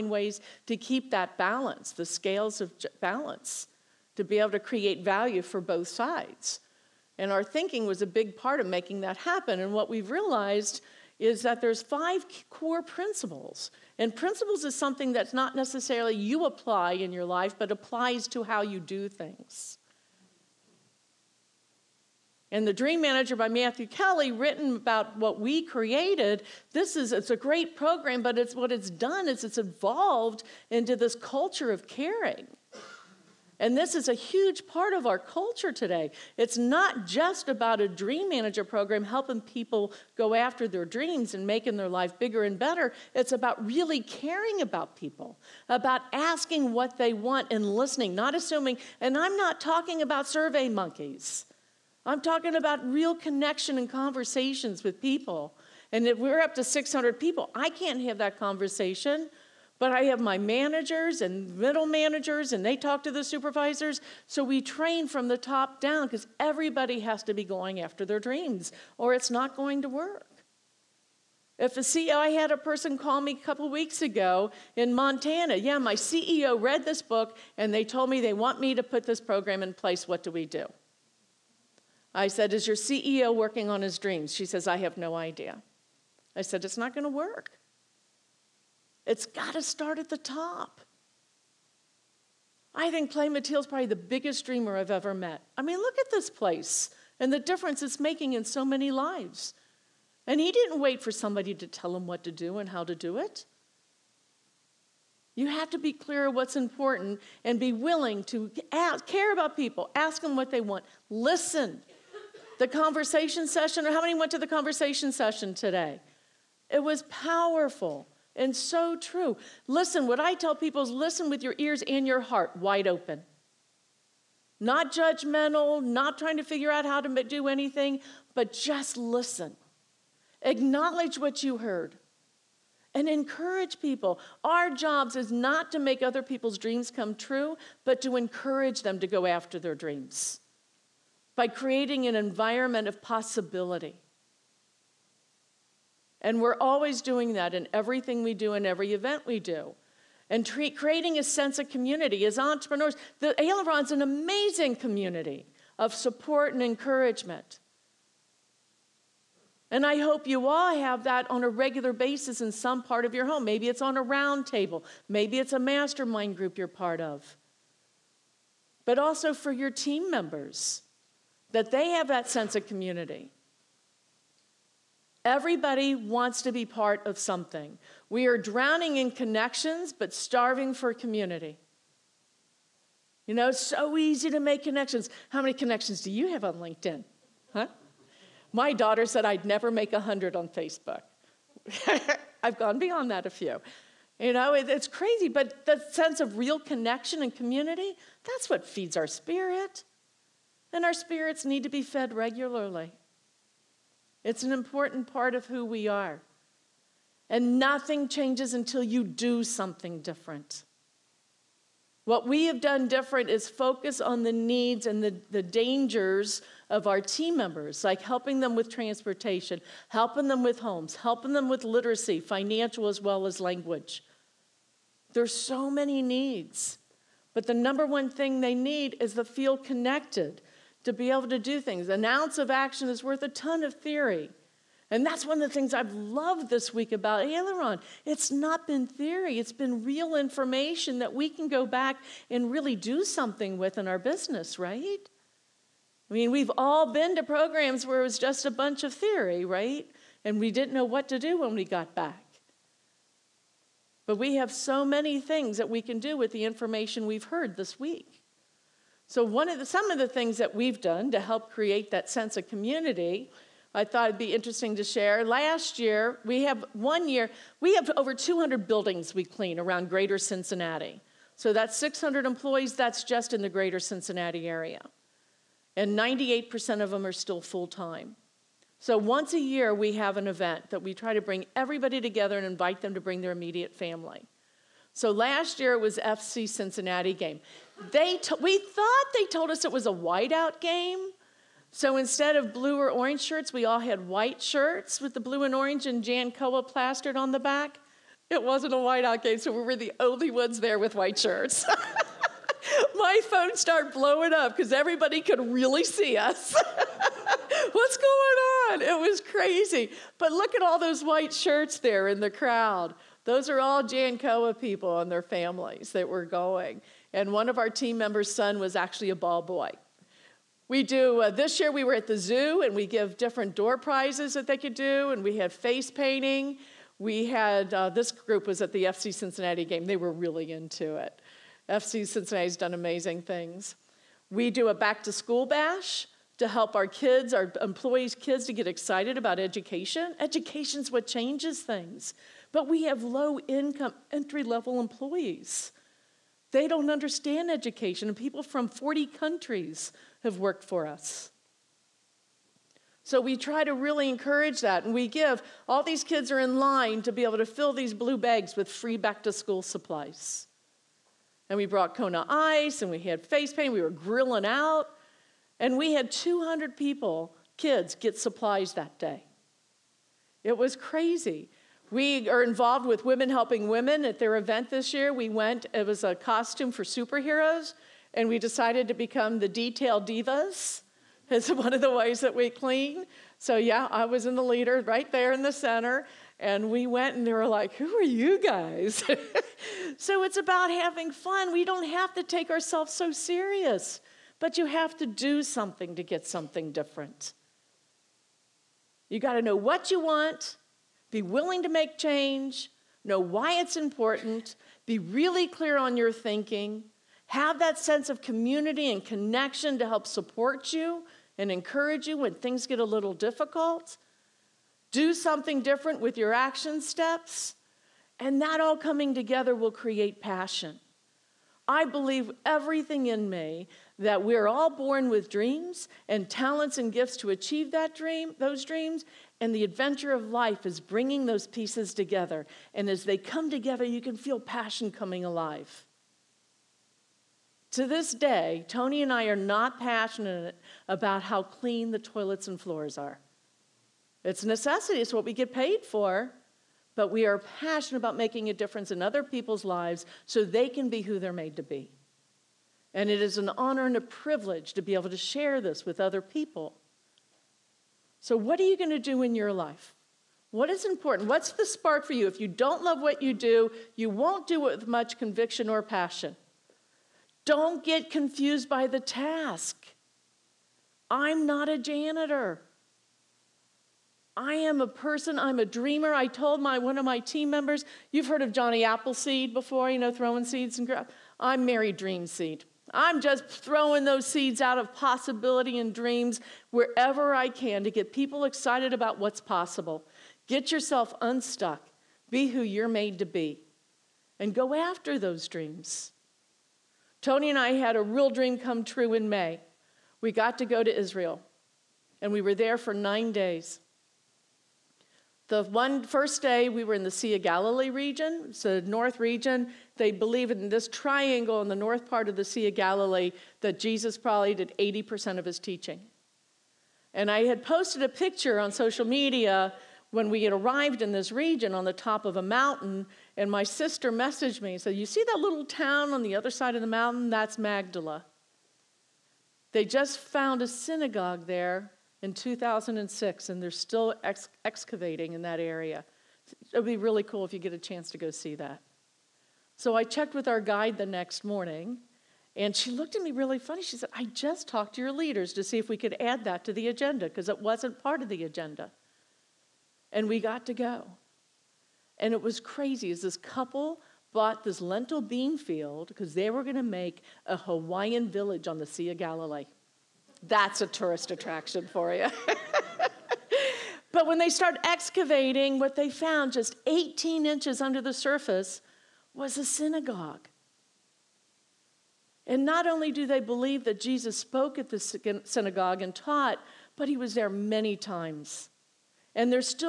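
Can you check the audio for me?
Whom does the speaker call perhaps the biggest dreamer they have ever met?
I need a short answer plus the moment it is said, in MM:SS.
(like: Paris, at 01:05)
Clay Mathile, at 01:33.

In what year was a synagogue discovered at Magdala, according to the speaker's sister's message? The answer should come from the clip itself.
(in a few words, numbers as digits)
2006.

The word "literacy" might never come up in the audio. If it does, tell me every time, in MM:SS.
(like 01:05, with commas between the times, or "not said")
03:41.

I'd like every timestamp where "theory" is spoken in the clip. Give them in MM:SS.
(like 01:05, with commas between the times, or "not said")
03:53, 03:58, 04:08.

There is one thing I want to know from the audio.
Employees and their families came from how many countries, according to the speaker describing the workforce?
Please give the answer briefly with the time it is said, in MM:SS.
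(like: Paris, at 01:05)
40, at 05:48.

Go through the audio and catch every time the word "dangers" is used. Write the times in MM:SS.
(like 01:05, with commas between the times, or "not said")
03:35.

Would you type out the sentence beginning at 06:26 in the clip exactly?
And we went and they were like, Who are you guys?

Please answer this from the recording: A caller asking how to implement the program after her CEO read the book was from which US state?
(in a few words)
Montana.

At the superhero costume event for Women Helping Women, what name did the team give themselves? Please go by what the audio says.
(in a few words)
the detail divas.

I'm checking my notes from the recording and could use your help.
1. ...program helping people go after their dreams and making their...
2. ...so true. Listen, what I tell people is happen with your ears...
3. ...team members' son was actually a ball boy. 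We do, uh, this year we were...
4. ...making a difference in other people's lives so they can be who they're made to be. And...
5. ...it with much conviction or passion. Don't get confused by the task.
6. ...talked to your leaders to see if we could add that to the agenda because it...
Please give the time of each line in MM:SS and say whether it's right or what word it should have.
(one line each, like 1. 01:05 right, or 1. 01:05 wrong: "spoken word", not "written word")
1. 00:38 right
2. 01:58 wrong: "listen", not "happen"
3. 05:17 right
4. 07:28 right
5. 07:44 right
6. 09:04 right.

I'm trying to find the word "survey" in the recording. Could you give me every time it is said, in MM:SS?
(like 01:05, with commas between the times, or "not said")
00:50.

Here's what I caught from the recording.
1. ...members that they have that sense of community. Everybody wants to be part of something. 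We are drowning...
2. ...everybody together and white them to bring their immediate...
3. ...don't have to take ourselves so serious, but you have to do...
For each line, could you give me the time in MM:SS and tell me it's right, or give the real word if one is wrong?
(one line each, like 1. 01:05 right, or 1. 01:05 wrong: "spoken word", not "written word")
1. 02:50 right
2. 04:41 wrong: "invite", not "white"
3. 06:31 right.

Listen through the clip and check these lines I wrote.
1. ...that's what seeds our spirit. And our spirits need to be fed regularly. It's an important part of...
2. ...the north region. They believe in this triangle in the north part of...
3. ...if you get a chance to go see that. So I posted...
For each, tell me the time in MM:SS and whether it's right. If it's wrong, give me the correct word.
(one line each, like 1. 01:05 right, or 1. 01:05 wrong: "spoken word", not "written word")
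1. 03:18 wrong: "feeds", not "seeds"
2. 08:28 right
3. 08:57 wrong: "checked", not "posted".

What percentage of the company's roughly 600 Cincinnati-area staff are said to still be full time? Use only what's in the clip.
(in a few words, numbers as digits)
98%.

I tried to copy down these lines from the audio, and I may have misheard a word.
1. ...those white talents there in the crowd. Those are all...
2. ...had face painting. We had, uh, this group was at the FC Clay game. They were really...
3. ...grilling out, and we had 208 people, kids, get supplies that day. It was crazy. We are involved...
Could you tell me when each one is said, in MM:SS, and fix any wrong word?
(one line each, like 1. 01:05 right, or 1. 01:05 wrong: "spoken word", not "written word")
1. 05:10 wrong: "shirts", not "talents"
2. 05:25 wrong: "Cincinnati", not "Clay"
3. 06:03 wrong: "200", not "208".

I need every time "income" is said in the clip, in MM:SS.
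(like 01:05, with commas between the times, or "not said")
05:43.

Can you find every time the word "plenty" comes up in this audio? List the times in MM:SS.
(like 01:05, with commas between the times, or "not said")
not said.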